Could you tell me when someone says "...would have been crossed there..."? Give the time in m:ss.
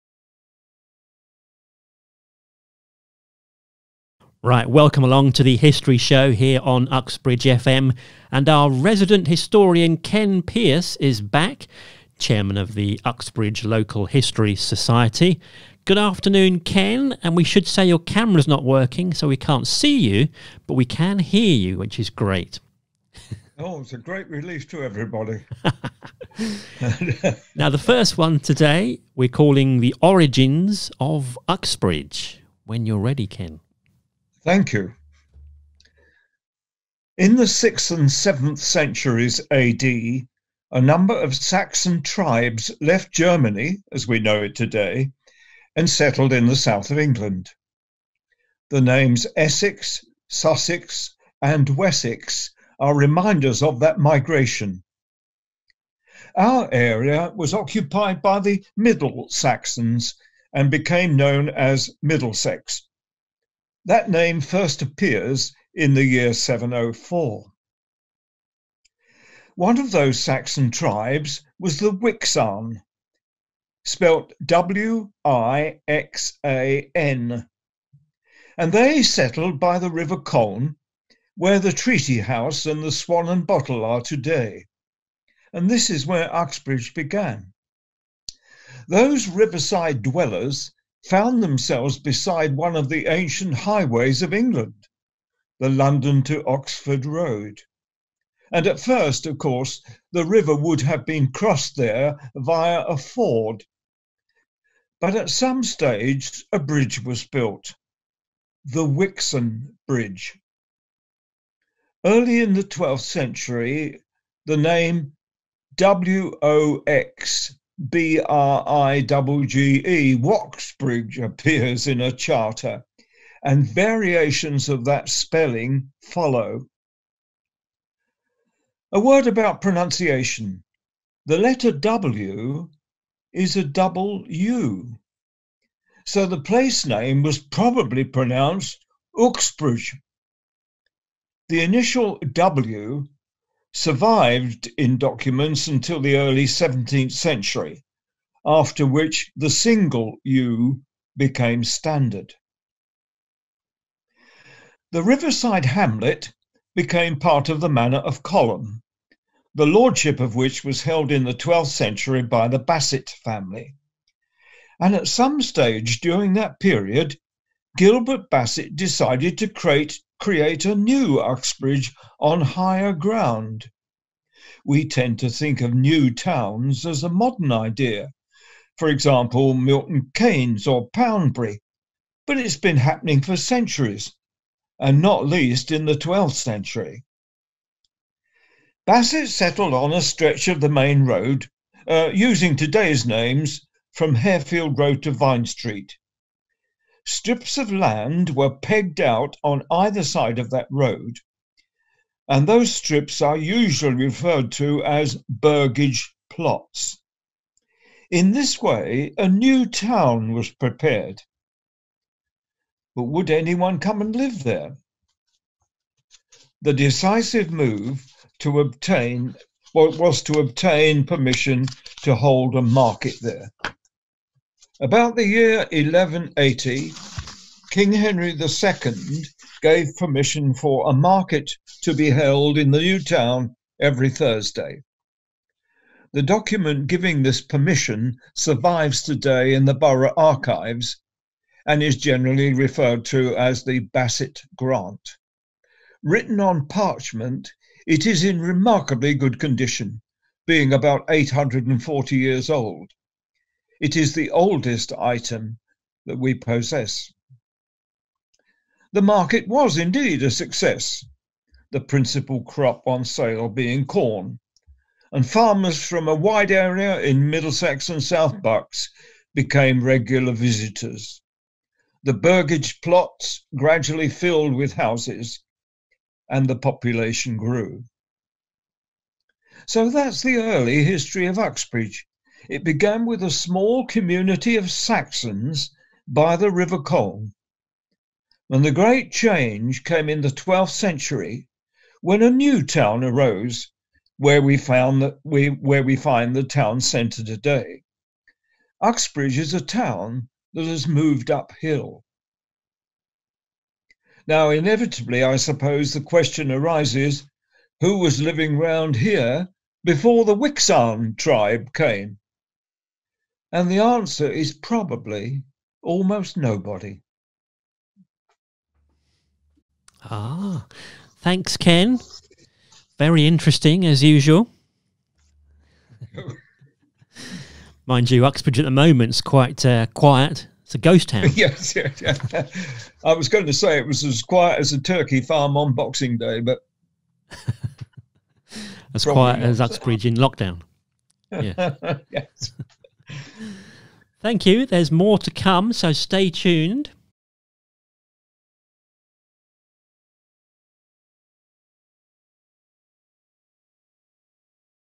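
1:40.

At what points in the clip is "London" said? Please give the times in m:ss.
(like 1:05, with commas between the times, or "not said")
1:35.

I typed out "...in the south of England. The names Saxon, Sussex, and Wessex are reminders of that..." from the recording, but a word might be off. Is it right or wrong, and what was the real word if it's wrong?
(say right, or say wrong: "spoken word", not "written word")
wrong: "Essex", not "Saxon".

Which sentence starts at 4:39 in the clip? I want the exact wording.
So that's the early history of Uxbridge, it began with a small community of Saxons by the River Colne.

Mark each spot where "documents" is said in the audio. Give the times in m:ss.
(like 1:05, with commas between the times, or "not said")
2:24, 3:56.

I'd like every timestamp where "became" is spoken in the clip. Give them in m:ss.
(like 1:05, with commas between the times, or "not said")
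1:00, 2:31, 2:36, 4:29.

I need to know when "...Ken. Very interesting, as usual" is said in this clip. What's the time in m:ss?
5:21.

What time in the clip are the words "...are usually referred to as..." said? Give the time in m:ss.
3:23.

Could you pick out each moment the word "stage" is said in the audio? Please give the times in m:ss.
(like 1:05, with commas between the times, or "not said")
1:45, 2:45.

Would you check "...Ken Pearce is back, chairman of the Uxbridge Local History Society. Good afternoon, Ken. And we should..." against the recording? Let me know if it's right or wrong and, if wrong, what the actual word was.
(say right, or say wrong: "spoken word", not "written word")
right.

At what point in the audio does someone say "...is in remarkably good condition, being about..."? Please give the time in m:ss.
4:08.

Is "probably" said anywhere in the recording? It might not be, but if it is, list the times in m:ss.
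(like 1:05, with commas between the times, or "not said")
2:17, 5:14.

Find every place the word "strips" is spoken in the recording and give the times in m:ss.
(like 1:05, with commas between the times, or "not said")
3:17, 3:22.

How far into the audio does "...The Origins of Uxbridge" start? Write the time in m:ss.
0:29.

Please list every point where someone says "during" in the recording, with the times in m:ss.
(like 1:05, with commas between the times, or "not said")
2:46.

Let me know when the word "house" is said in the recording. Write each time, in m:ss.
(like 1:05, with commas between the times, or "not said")
1:22, 4:34.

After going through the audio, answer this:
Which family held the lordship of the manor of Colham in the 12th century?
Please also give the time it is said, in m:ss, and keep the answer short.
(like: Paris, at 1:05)
Bassett family, at 2:42.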